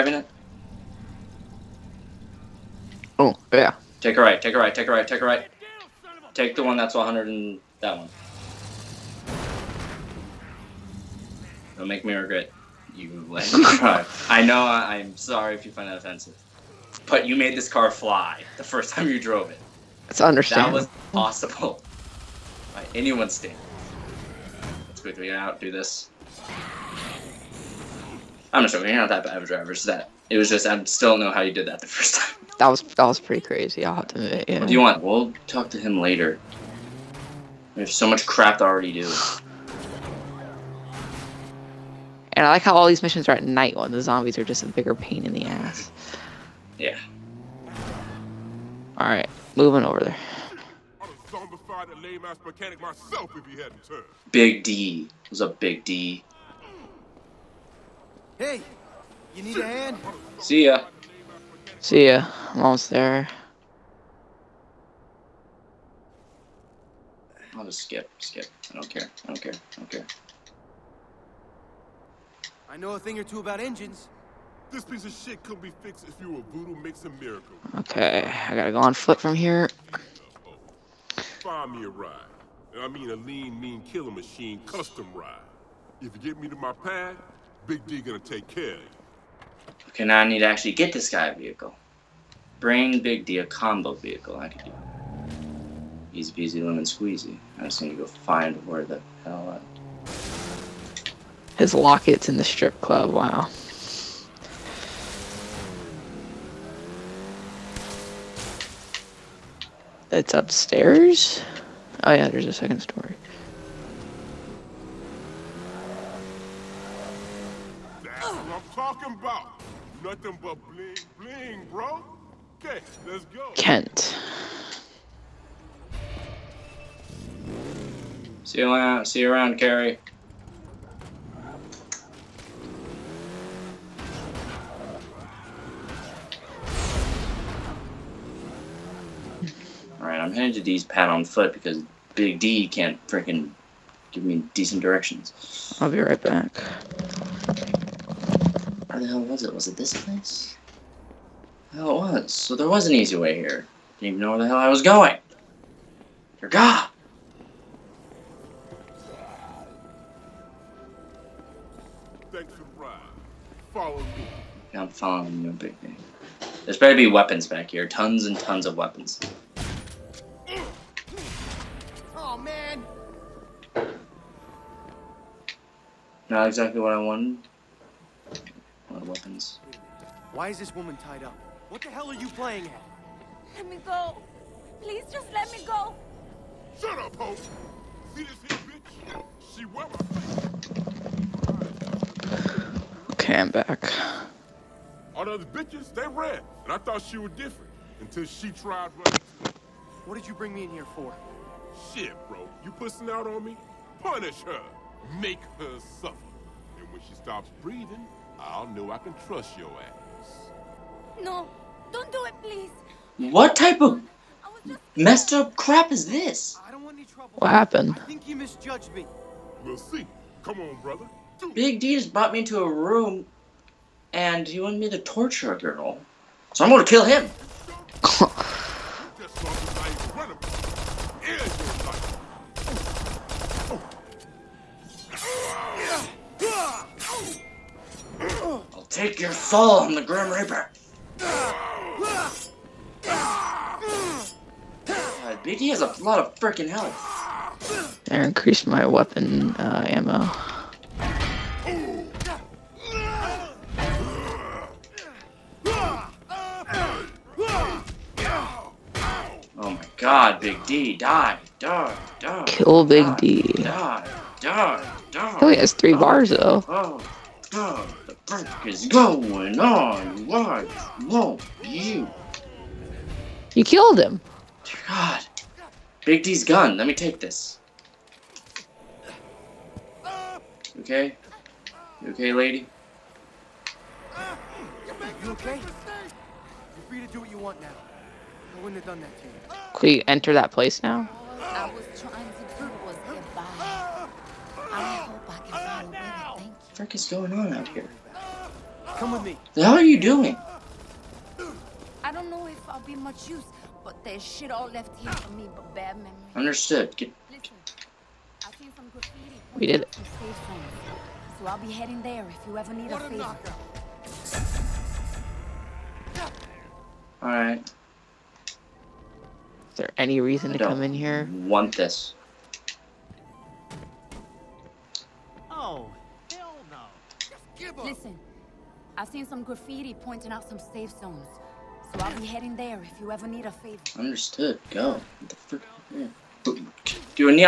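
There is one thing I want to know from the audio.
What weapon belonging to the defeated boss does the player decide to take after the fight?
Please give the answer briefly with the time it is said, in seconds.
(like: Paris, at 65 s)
Big D's gun, at 276 s.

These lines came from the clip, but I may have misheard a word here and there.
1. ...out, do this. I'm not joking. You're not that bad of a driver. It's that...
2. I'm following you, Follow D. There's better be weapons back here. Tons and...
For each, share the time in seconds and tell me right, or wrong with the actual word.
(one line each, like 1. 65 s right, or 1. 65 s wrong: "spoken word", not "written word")
1. 25 s right
2. 164 s wrong: "Big", not "Follow".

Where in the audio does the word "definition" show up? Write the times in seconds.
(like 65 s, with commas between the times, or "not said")
not said.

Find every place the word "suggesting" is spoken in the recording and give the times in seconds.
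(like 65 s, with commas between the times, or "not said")
not said.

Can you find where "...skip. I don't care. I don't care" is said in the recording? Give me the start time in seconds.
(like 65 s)
68 s.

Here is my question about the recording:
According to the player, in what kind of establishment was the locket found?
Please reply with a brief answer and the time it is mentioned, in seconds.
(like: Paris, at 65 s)
strip club, at 102 s.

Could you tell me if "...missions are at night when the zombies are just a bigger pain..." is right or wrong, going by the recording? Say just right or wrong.
right.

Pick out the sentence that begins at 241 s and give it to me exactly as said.
God, Biggie has a lot of freaking health.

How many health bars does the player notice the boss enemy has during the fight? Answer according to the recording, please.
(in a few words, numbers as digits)
3.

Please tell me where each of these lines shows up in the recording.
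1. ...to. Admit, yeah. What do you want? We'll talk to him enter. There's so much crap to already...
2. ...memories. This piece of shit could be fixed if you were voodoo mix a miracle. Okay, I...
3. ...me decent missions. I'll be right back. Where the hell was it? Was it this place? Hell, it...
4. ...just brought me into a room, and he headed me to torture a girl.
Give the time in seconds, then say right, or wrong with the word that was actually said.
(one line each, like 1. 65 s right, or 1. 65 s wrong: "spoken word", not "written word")
1. 34 s wrong: "later", not "enter"
2. 73 s wrong: "engines", not "memories"
3. 144 s wrong: "directions", not "missions"
4. 221 s wrong: "wanted", not "headed".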